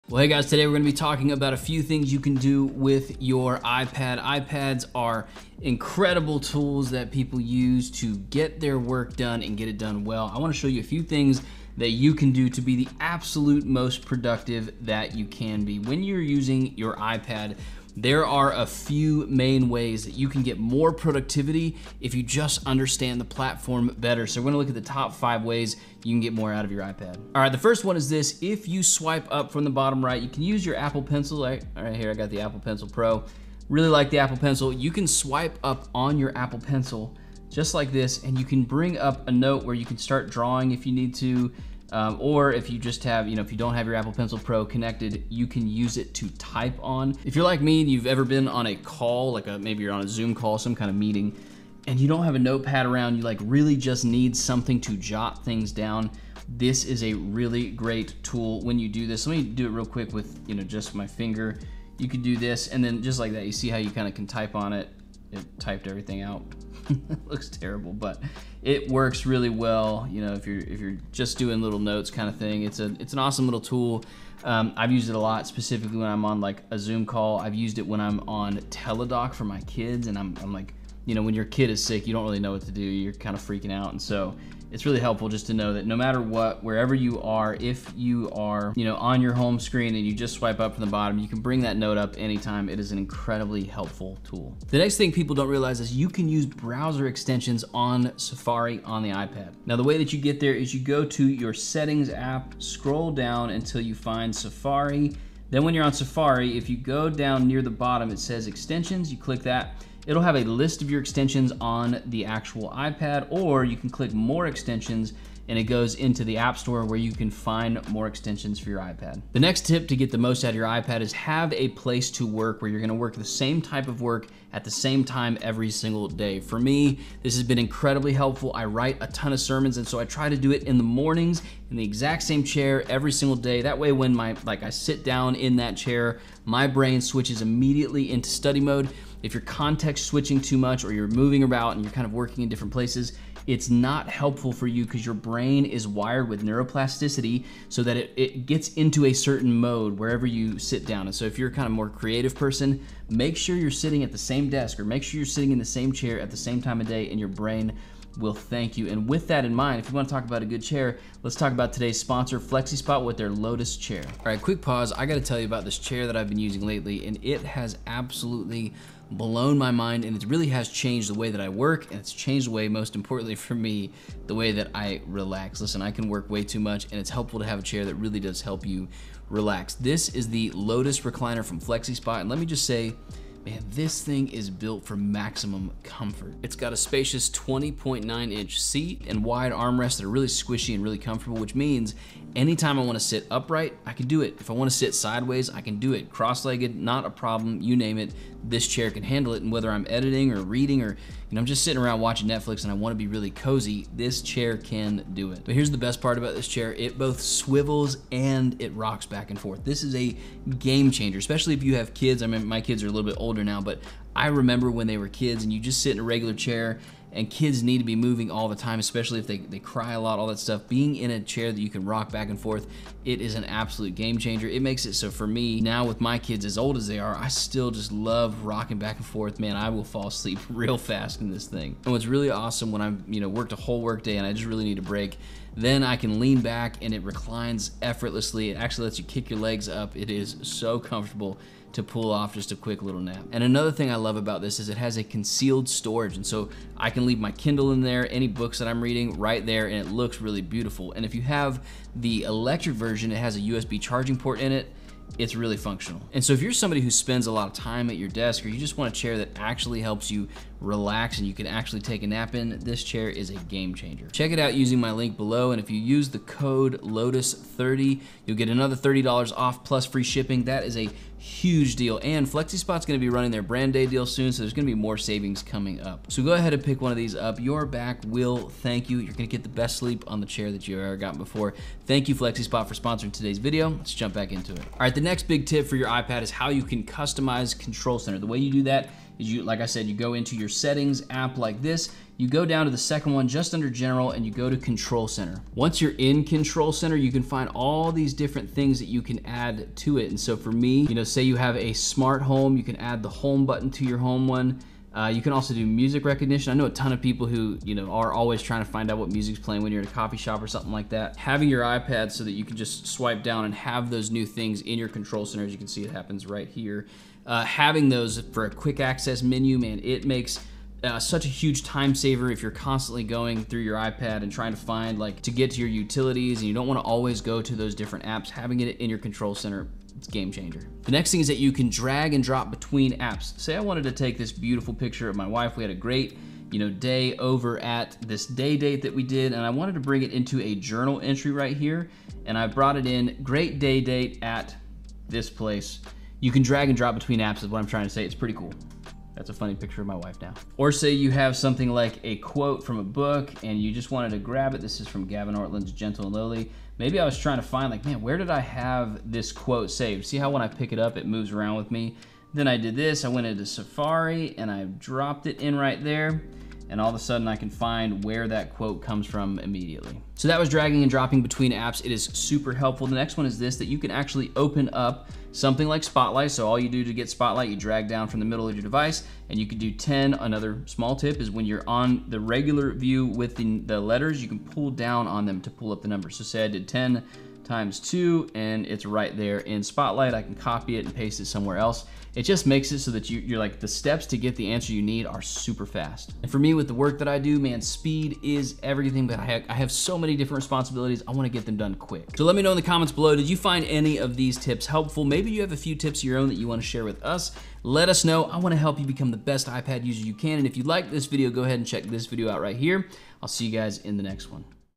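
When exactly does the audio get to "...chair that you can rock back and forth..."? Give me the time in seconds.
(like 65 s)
221 s.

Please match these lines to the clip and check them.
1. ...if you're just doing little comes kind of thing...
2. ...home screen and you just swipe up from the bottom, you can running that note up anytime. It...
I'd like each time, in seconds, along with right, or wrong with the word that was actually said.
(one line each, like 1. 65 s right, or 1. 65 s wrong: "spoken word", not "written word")
1. 70 s wrong: "notes", not "comes"
2. 89 s wrong: "bring", not "running".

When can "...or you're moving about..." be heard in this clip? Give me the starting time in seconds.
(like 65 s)
140 s.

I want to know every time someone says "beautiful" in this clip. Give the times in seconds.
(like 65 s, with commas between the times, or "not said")
250 s, 334 s.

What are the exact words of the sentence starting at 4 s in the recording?
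iPads are incredible tools that people use to get their work done and get it done well.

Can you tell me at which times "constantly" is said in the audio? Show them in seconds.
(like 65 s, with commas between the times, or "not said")
322 s.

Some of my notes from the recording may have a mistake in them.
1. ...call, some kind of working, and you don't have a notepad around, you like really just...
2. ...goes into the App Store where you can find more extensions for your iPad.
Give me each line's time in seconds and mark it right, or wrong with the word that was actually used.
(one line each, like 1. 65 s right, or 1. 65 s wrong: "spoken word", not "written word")
1. 50 s wrong: "meeting", not "working"
2. 115 s right.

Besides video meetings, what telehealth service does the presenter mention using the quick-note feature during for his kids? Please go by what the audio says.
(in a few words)
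Teladoc.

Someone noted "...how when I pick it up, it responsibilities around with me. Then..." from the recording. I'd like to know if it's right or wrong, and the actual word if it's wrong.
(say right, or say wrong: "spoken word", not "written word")
wrong: "moves", not "responsibilities".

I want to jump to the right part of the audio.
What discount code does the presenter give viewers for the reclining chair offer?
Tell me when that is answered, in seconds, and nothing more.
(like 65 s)
266 s.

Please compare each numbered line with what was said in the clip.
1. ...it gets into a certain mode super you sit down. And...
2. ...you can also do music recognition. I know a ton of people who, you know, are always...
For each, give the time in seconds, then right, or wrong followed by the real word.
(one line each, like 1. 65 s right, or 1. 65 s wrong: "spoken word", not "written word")
1. 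148 s wrong: "wherever", not "super"
2. 305 s right.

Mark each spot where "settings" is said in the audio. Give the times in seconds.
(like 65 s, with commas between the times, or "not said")
101 s, 290 s.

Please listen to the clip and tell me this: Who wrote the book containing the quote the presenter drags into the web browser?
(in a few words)
Gavin Ortlund.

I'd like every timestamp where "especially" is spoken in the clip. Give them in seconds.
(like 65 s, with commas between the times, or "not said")
211 s, 218 s.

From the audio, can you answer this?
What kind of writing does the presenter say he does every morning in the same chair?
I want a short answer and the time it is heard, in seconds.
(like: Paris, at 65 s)
Sermons, at 129 s.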